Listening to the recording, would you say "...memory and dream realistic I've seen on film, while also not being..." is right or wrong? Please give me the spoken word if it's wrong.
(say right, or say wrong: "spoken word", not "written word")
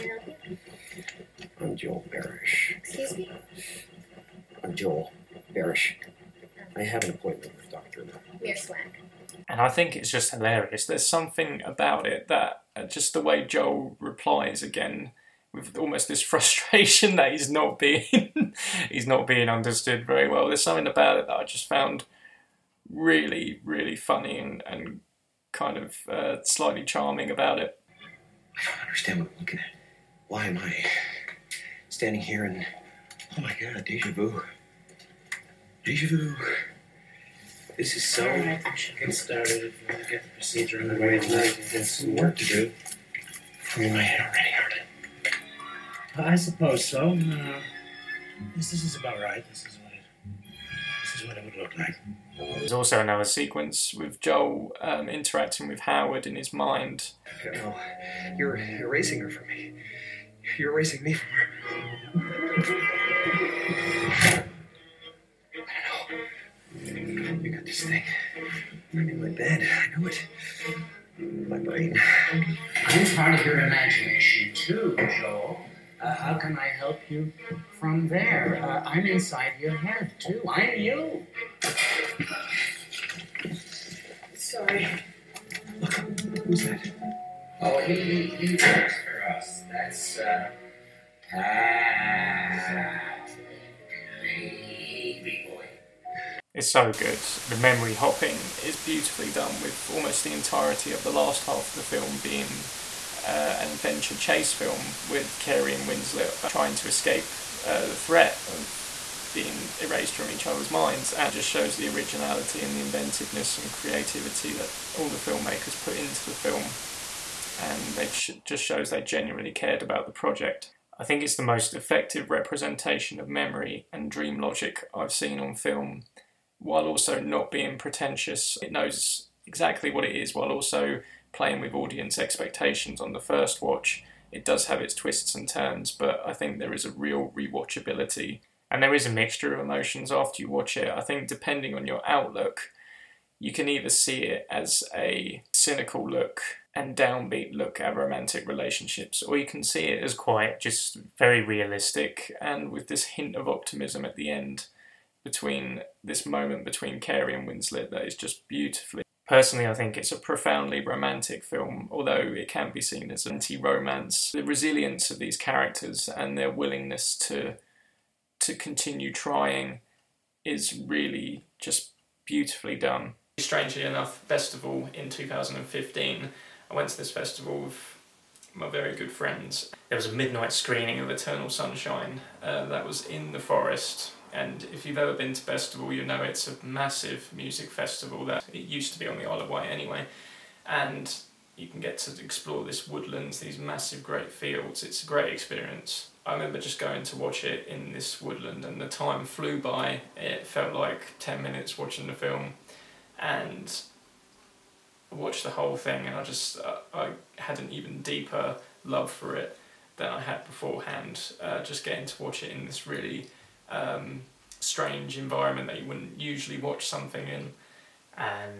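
wrong: "logic", not "realistic".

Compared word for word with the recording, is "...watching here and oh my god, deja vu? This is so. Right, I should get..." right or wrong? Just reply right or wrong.
wrong.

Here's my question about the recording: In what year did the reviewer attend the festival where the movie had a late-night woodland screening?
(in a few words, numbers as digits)
2015.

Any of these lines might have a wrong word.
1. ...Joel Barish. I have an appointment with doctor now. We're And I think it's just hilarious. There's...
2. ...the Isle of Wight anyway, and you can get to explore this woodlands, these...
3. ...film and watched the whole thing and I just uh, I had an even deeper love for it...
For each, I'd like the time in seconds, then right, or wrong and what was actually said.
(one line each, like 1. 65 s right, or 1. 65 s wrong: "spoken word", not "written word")
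1. 4 s right
2. 189 s right
3. 202 s right.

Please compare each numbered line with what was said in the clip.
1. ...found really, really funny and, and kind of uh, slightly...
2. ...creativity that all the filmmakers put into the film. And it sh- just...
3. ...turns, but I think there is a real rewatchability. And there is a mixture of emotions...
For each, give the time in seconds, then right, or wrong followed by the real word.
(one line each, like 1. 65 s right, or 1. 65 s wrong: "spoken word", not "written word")
1. 21 s right
2. 113 s right
3. 135 s right.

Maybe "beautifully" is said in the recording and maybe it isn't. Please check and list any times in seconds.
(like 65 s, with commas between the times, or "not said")
98 s, 158 s, 172 s.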